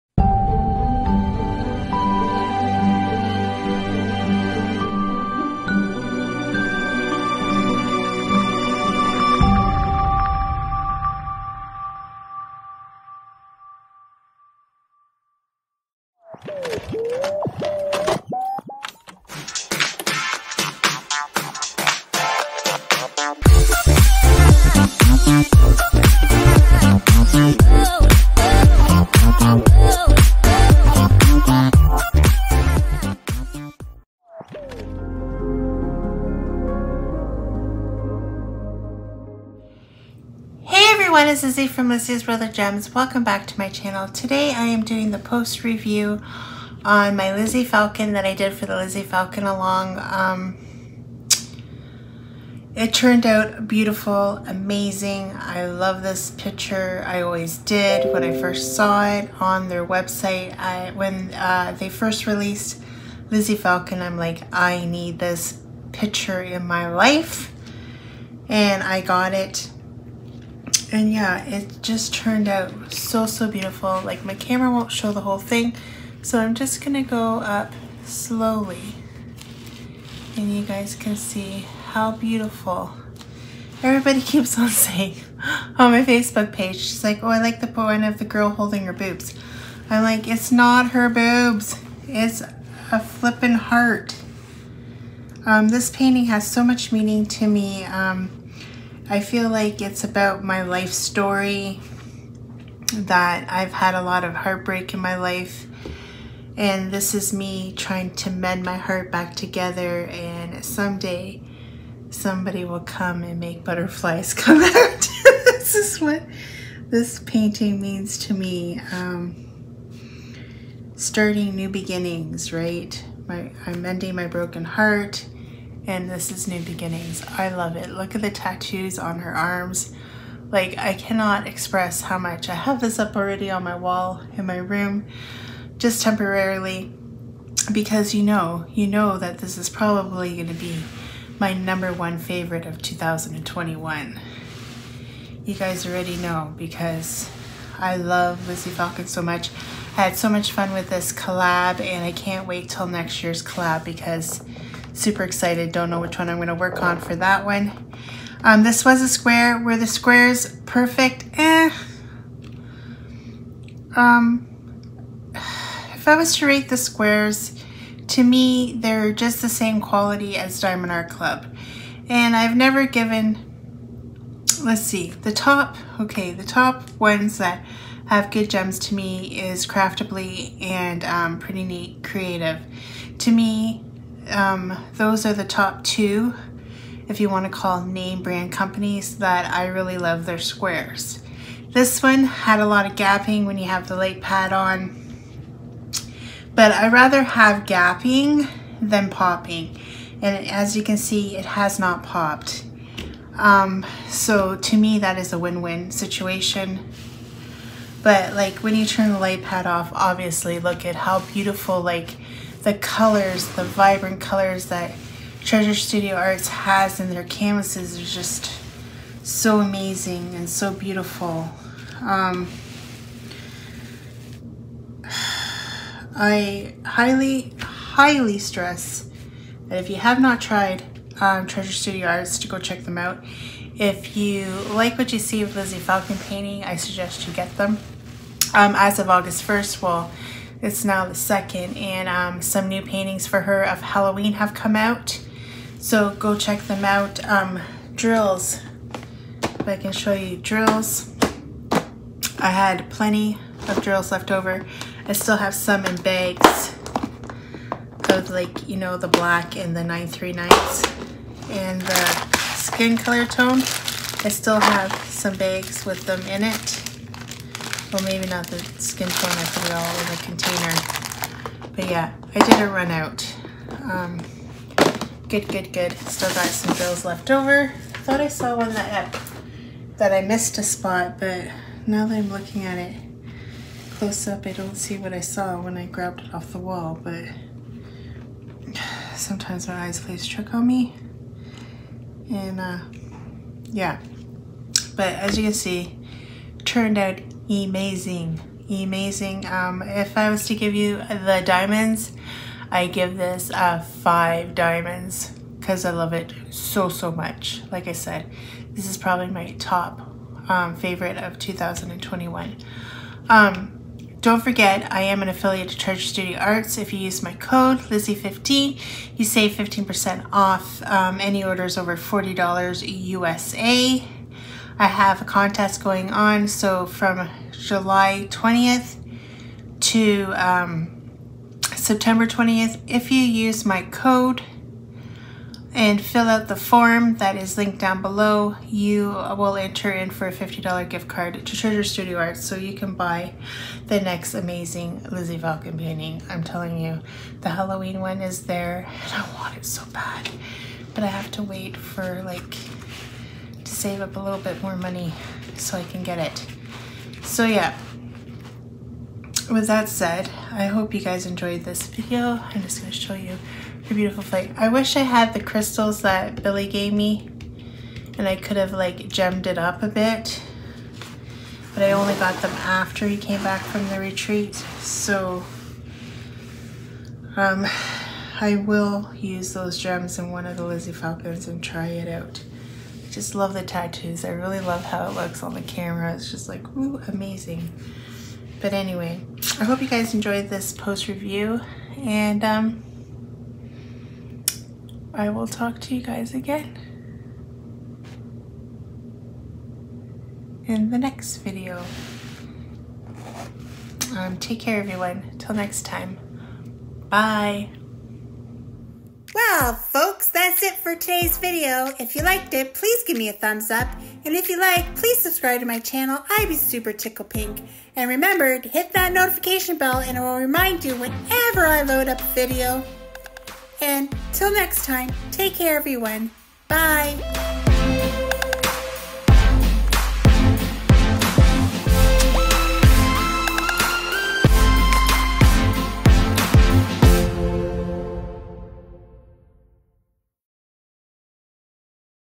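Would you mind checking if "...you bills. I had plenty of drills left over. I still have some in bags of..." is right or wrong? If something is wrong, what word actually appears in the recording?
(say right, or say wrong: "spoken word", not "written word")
wrong: "drills", not "bills".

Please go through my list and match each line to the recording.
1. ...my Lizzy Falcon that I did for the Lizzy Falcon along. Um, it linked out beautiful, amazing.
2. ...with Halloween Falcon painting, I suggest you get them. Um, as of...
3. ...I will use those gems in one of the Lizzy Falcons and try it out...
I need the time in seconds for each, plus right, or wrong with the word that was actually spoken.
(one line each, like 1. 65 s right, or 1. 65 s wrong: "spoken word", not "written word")
1. 47 s wrong: "turned", not "linked"
2. 235 s wrong: "Lizzy", not "Halloween"
3. 378 s right.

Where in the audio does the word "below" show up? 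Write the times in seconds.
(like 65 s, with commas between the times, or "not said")
338 s.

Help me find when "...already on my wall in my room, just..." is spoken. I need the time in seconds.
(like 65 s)
133 s.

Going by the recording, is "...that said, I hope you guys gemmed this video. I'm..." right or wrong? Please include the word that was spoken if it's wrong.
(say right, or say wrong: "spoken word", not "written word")
wrong: "enjoyed", not "gemmed".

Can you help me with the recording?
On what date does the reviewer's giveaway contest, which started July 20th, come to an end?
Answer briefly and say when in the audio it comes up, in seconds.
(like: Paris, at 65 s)
September 20th, at 331 s.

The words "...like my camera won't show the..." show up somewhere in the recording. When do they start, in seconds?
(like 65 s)
74 s.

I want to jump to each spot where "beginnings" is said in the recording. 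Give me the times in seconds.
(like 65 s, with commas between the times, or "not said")
121 s, 126 s.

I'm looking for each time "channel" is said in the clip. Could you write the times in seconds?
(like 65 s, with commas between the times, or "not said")
43 s, 415 s.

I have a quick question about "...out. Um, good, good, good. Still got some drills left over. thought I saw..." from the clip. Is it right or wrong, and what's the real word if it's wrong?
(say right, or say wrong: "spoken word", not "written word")
wrong: "bills", not "drills".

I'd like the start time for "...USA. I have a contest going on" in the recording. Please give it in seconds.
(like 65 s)
322 s.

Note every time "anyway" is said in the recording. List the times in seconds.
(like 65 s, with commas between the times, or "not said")
388 s.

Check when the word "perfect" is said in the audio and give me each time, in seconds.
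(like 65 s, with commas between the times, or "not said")
160 s.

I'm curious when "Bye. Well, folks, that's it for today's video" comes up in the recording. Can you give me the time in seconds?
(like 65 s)
407 s.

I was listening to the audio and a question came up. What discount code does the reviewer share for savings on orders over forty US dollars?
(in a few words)
Lizzie15.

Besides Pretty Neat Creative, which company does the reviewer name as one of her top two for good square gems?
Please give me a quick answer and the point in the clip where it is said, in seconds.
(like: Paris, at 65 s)
Craftably, at 179 s.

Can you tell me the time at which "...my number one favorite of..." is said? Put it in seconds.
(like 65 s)
141 s.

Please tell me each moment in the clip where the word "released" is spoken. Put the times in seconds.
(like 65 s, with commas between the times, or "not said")
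62 s.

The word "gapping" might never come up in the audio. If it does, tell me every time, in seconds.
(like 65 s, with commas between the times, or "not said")
192 s, 197 s.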